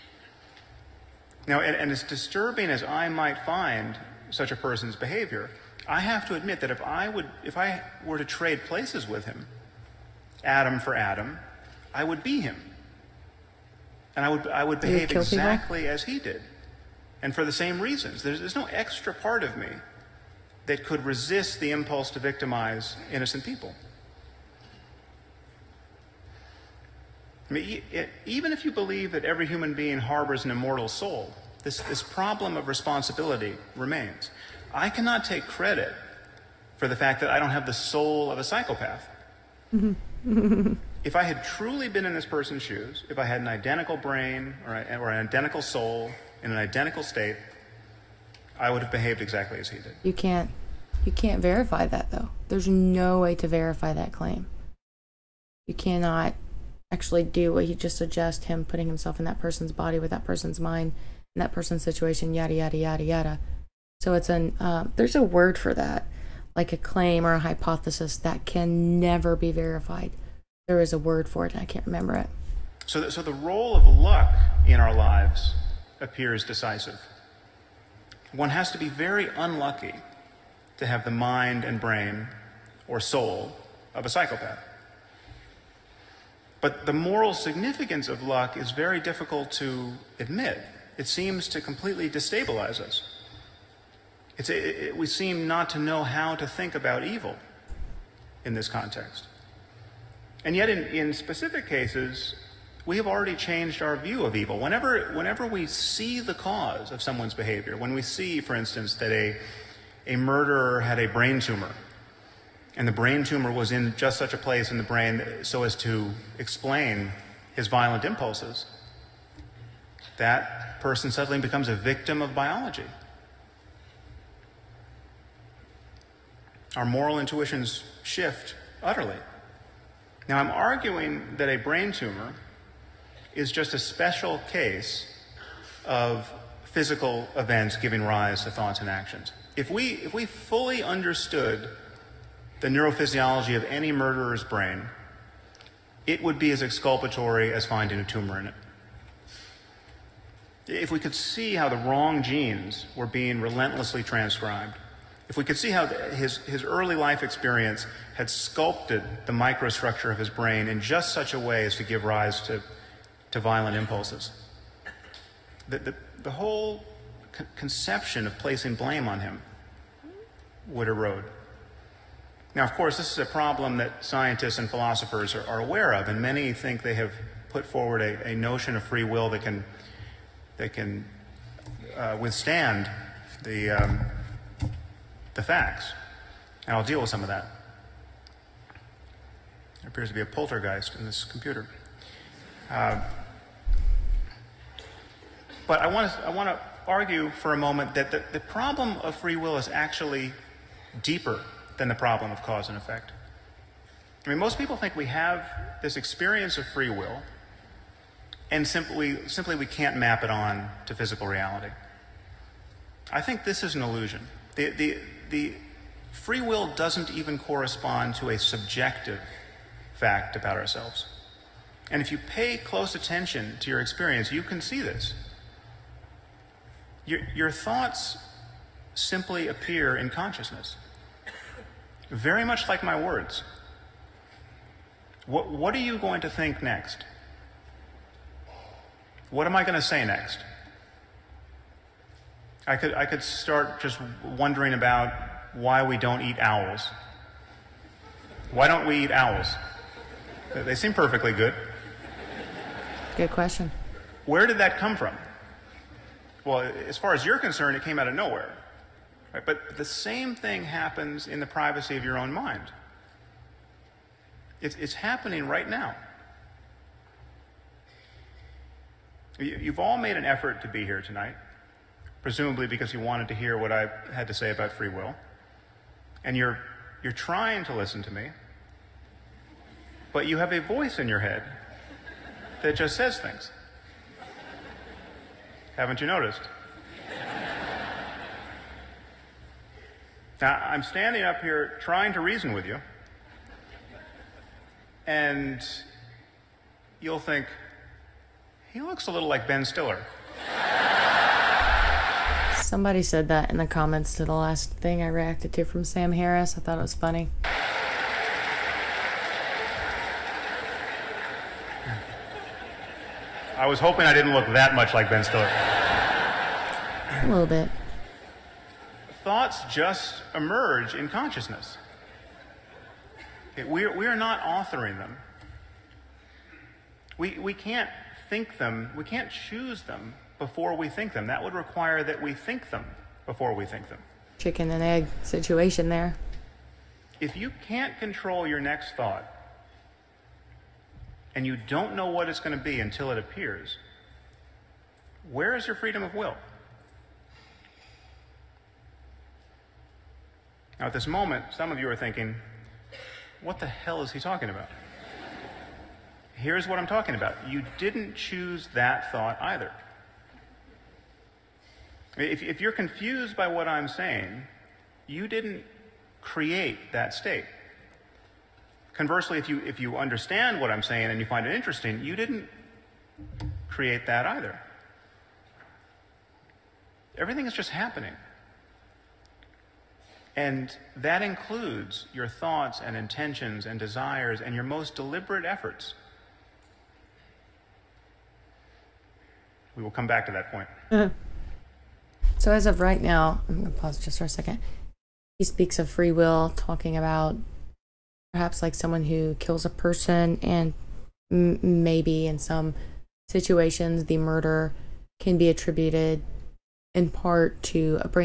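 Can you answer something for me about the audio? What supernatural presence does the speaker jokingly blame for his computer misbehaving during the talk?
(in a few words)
A poltergeist.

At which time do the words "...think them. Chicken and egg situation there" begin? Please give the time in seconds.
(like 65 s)
333 s.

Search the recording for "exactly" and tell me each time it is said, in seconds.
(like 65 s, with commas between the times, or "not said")
15 s, 49 s.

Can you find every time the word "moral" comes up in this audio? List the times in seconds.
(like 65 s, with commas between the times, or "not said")
86 s, 126 s.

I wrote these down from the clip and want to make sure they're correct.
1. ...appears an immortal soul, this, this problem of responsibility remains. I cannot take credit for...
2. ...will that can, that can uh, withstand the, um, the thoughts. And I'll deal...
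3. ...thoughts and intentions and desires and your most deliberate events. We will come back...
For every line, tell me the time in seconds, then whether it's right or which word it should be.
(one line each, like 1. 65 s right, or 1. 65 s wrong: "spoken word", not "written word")
1. 29 s wrong: "harbors", not "appears"
2. 179 s wrong: "facts", not "thoughts"
3. 382 s wrong: "efforts", not "events".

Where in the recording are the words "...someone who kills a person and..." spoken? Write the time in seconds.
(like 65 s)
398 s.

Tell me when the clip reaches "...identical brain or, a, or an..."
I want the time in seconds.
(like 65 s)
43 s.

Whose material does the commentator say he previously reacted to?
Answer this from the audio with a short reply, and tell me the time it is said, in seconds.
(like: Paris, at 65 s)
Sam Harris, at 305 s.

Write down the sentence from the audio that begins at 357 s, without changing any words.
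You didn't choose that thought either.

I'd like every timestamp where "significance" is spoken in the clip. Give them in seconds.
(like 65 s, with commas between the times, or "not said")
87 s.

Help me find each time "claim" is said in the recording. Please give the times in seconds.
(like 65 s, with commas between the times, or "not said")
54 s, 66 s.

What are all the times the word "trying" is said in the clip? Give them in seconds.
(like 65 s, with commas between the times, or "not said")
277 s, 291 s.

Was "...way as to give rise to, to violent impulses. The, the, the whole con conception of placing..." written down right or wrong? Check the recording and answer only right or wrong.
right.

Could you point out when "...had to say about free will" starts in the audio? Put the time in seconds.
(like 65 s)
274 s.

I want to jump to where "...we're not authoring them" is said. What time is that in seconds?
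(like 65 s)
323 s.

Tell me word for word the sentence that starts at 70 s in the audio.
There is a word for it, and I can't remember it.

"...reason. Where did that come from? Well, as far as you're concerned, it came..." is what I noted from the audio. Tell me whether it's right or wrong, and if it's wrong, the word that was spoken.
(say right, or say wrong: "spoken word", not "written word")
wrong: "question", not "reason".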